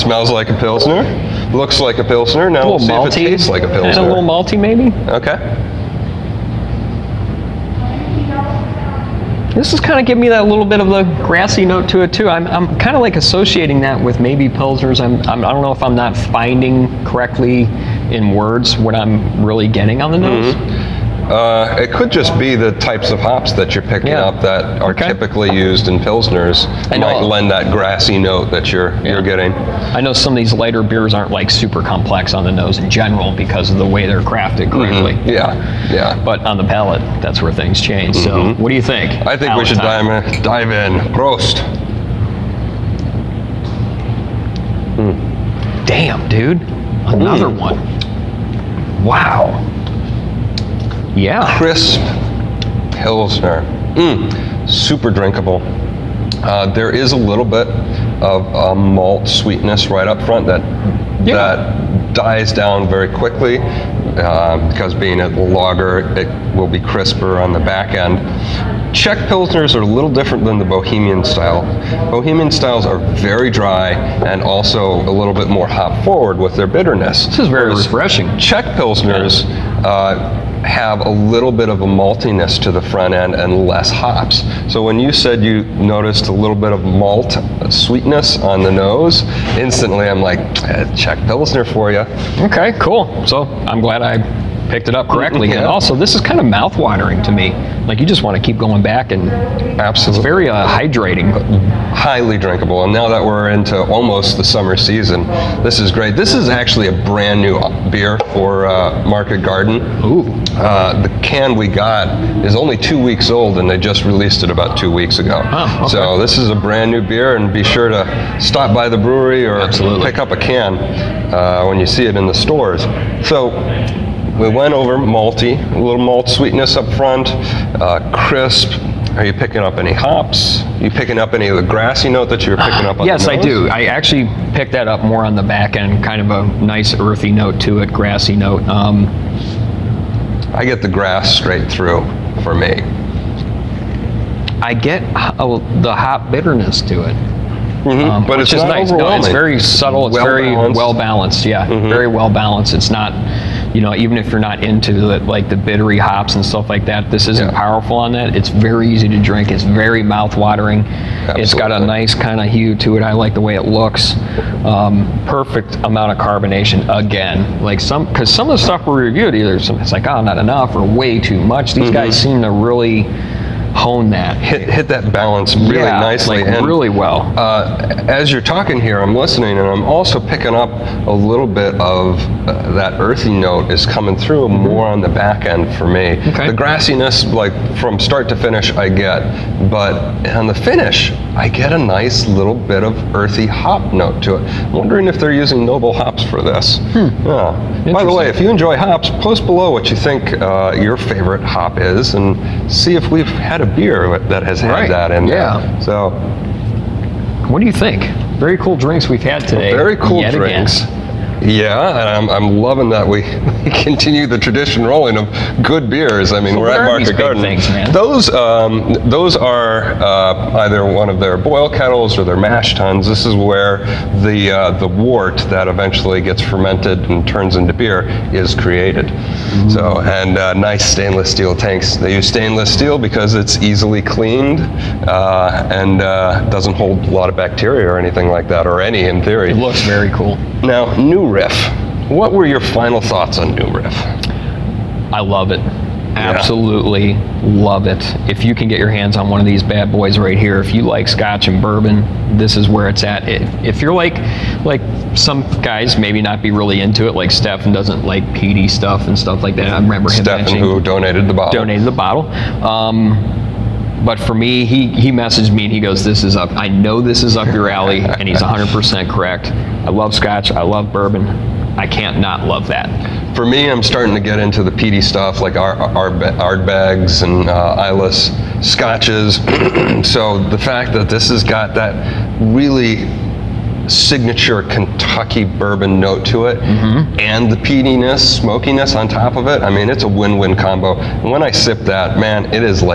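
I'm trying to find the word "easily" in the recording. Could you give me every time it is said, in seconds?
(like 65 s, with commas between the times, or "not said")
233 s.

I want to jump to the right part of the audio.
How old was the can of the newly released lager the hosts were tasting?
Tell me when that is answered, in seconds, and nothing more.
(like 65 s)
112 s.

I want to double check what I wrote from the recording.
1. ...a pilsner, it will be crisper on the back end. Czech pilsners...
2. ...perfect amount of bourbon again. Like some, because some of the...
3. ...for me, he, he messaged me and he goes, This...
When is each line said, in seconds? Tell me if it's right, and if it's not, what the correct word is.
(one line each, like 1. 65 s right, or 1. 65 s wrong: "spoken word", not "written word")
1. 65 s wrong: "lager", not "pilsner"
2. 165 s wrong: "carbonation", not "bourbon"
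3. 264 s right.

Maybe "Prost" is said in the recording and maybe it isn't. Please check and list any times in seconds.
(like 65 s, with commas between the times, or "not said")
41 s.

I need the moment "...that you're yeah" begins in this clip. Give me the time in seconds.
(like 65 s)
28 s.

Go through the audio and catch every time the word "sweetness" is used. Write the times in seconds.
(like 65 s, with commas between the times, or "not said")
59 s, 87 s, 126 s.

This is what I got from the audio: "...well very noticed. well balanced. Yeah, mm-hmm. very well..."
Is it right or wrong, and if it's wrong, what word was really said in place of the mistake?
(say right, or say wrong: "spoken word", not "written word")
wrong: "balanced", not "noticed".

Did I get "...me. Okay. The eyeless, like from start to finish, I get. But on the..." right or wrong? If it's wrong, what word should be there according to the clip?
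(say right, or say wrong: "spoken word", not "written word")
wrong: "grassiness", not "eyeless".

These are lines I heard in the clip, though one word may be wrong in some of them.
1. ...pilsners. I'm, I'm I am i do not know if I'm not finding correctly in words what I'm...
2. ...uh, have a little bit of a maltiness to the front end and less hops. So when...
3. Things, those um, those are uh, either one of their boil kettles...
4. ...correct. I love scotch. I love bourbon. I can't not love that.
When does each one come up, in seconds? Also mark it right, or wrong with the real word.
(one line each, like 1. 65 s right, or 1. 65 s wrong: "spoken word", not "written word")
1. 14 s right
2. 79 s right
3. 217 s right
4. 269 s right.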